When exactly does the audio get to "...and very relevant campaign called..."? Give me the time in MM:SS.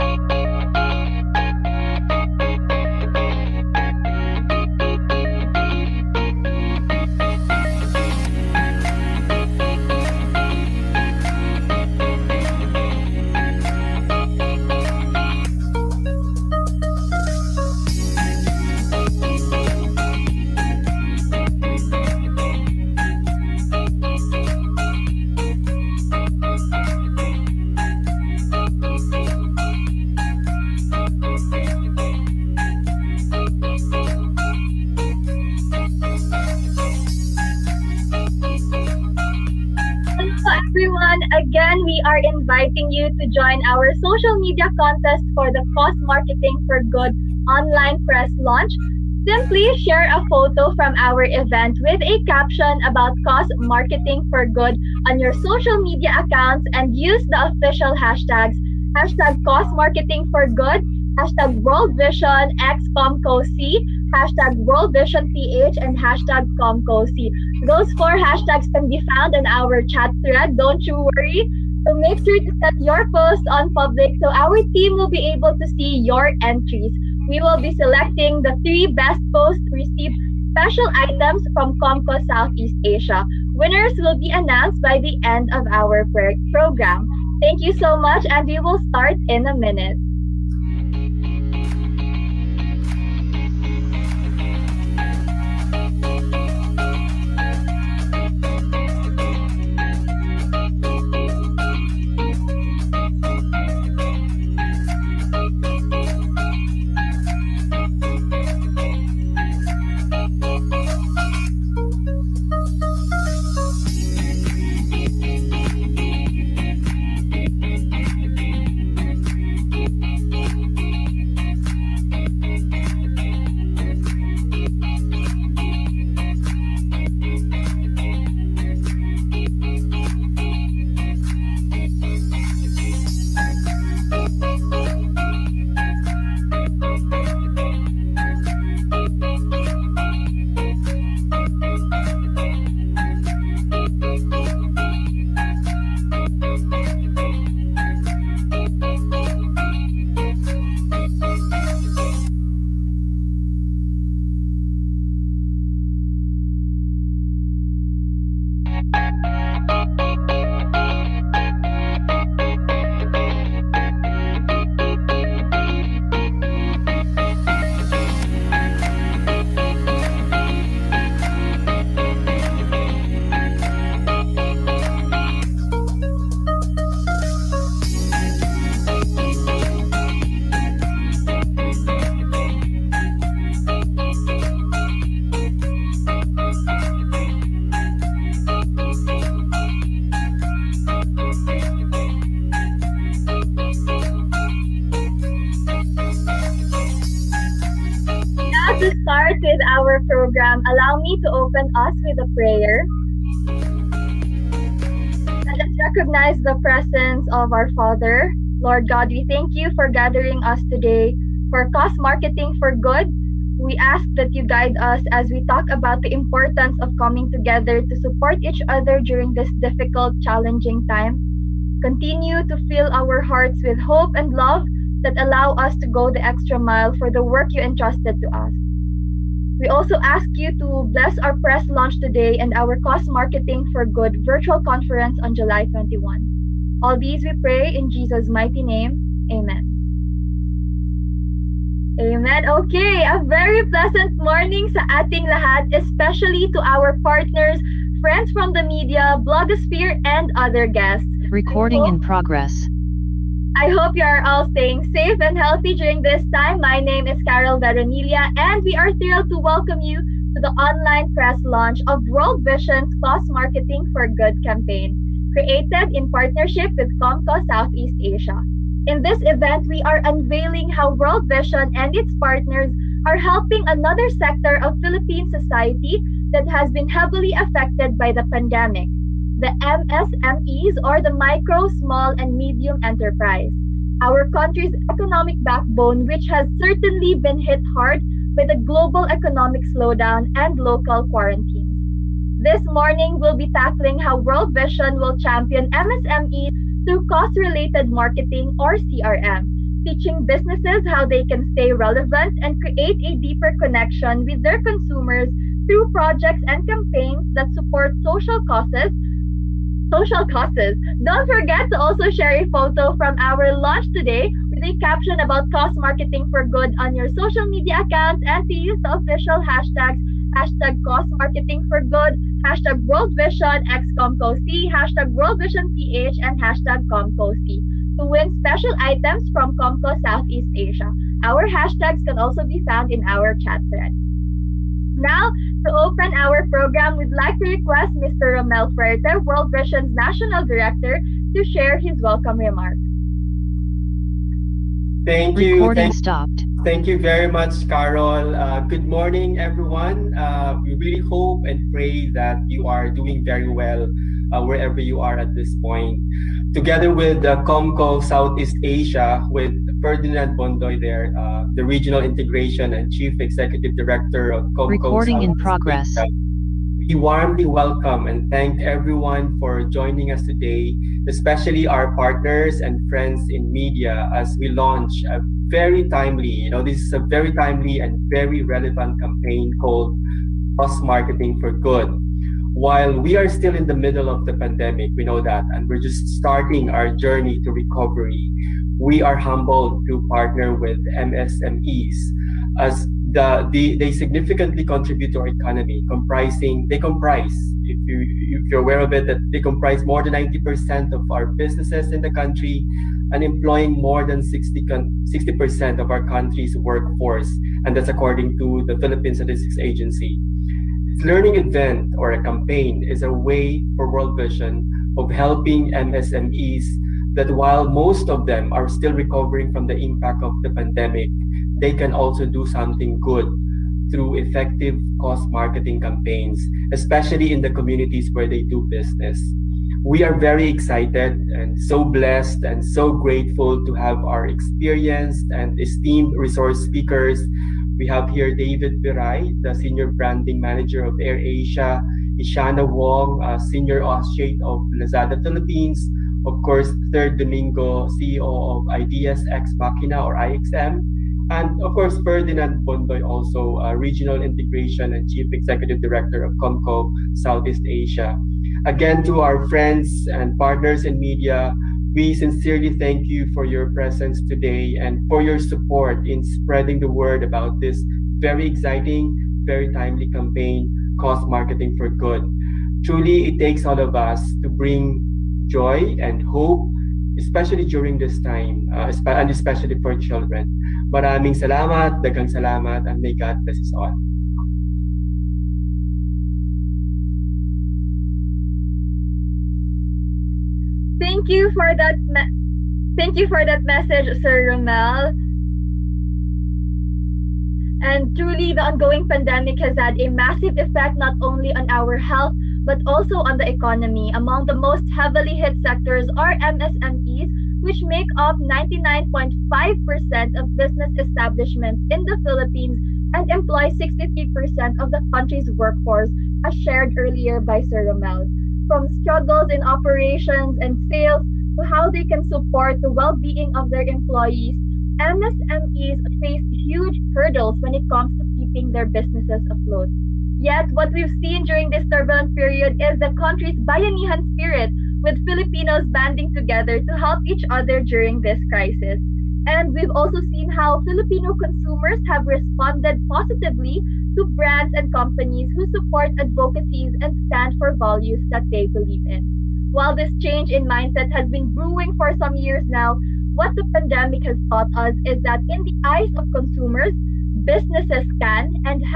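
06:17.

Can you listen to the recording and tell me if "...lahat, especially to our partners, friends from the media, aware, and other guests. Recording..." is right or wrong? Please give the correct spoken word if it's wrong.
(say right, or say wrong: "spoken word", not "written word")
wrong: "blogosphere", not "aware".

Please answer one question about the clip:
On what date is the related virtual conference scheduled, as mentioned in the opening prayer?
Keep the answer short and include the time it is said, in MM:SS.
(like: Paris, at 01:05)
July 21, at 03:55.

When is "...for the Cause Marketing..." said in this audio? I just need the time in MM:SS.
00:45.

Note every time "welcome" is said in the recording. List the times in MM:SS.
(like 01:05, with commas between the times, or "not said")
04:19, 05:42, 06:07.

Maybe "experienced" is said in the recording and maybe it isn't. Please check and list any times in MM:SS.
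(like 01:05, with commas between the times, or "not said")
07:14.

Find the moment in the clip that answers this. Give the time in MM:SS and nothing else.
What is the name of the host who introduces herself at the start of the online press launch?
04:17.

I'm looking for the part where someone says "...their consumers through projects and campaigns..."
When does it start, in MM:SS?
05:04.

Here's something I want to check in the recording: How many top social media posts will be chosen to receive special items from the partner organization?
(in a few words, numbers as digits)
3.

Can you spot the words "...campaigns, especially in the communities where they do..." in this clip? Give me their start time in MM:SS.
07:05.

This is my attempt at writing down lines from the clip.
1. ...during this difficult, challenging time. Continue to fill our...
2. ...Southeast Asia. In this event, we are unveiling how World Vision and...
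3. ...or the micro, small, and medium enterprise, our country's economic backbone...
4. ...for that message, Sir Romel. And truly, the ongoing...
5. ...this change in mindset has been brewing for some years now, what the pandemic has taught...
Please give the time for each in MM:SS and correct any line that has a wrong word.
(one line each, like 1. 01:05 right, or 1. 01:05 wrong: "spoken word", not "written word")
1. 03:38 right
2. 04:27 right
3. 04:40 right
4. 08:13 right
5. 09:09 right.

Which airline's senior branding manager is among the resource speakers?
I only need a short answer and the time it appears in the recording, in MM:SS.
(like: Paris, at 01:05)
AirAsia, at 07:20.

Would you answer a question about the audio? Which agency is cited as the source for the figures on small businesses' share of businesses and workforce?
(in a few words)
Philippine Statistics Agency.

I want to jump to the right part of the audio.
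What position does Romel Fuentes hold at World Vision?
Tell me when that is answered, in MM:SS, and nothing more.
05:39.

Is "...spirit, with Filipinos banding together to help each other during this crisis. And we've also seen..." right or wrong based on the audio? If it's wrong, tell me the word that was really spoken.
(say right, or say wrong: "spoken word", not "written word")
right.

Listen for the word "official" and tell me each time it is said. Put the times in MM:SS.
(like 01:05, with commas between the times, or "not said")
00:57, 05:18.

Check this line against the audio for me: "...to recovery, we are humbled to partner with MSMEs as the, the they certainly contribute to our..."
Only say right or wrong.
wrong.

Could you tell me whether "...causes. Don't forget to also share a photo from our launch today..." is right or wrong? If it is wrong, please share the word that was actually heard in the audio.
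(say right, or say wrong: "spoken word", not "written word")
right.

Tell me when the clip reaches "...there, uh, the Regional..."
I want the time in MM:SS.
06:00.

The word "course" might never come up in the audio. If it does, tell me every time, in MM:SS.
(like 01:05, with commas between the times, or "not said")
07:26, 07:31.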